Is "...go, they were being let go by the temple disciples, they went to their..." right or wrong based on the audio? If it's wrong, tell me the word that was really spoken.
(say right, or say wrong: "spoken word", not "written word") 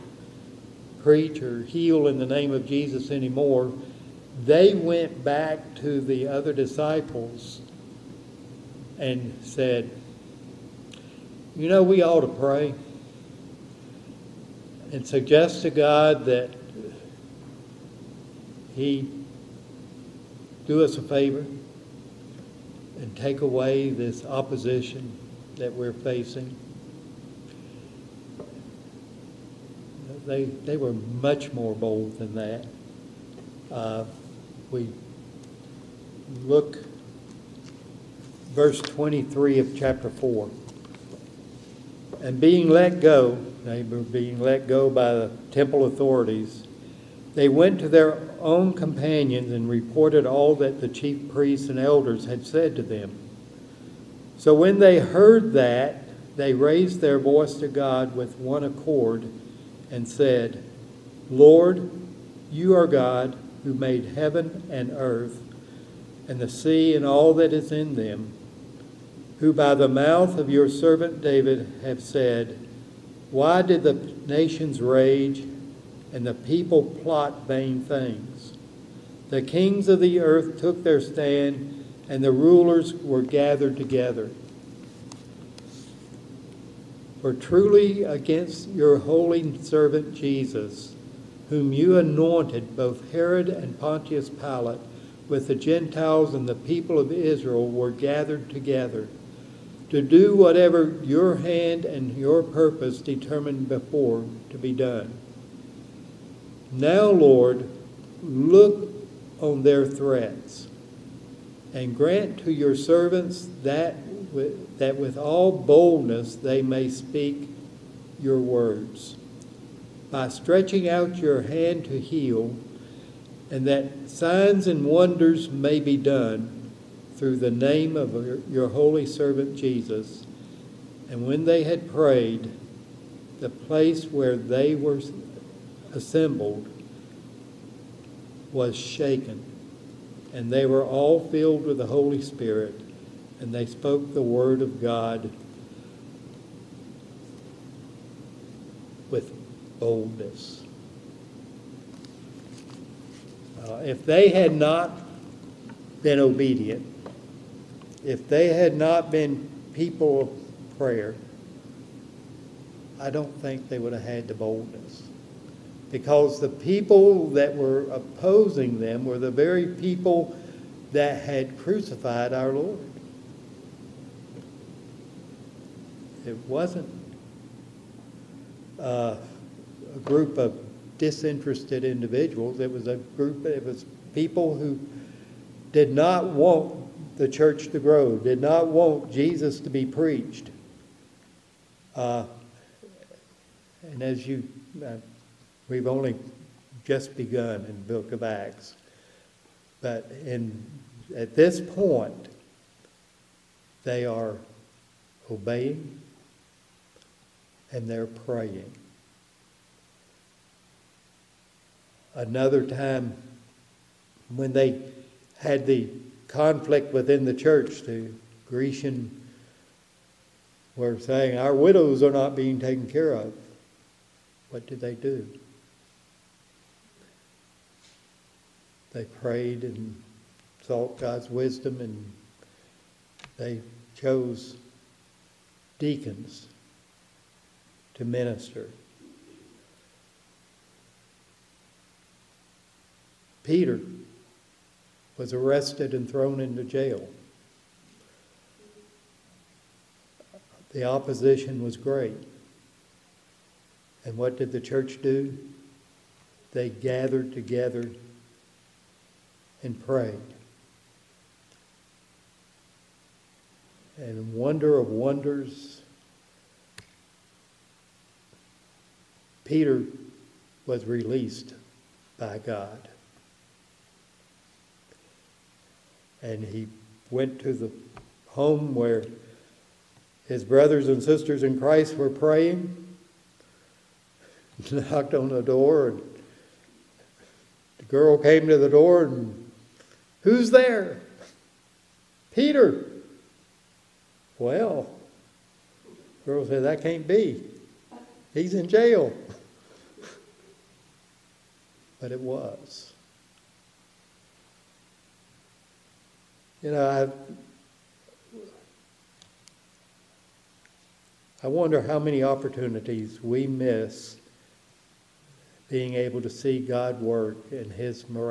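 wrong: "authorities", not "disciples".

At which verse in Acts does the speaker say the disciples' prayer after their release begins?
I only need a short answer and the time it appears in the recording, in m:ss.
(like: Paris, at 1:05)
23, at 0:38.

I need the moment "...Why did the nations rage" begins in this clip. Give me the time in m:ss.
1:13.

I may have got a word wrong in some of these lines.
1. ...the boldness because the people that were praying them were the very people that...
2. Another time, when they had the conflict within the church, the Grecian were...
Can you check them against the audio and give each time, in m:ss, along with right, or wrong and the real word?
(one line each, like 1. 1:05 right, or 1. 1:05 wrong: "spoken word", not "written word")
1. 2:44 wrong: "opposing", not "praying"
2. 3:32 right.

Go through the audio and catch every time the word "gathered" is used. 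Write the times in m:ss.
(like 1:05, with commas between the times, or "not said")
1:23, 1:37, 4:16.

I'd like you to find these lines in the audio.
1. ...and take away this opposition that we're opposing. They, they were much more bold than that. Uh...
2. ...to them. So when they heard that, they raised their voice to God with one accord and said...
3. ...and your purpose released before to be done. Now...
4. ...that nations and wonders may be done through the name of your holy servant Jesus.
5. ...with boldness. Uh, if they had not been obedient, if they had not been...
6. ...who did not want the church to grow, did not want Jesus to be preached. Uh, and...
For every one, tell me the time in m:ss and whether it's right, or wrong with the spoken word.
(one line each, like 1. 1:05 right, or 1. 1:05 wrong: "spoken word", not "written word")
1. 0:23 wrong: "facing", not "opposing"
2. 0:52 right
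3. 1:41 wrong: "determined", not "released"
4. 2:03 wrong: "signs", not "nations"
5. 2:29 right
6. 3:04 right.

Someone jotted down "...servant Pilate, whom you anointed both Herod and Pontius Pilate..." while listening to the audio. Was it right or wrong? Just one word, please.
wrong.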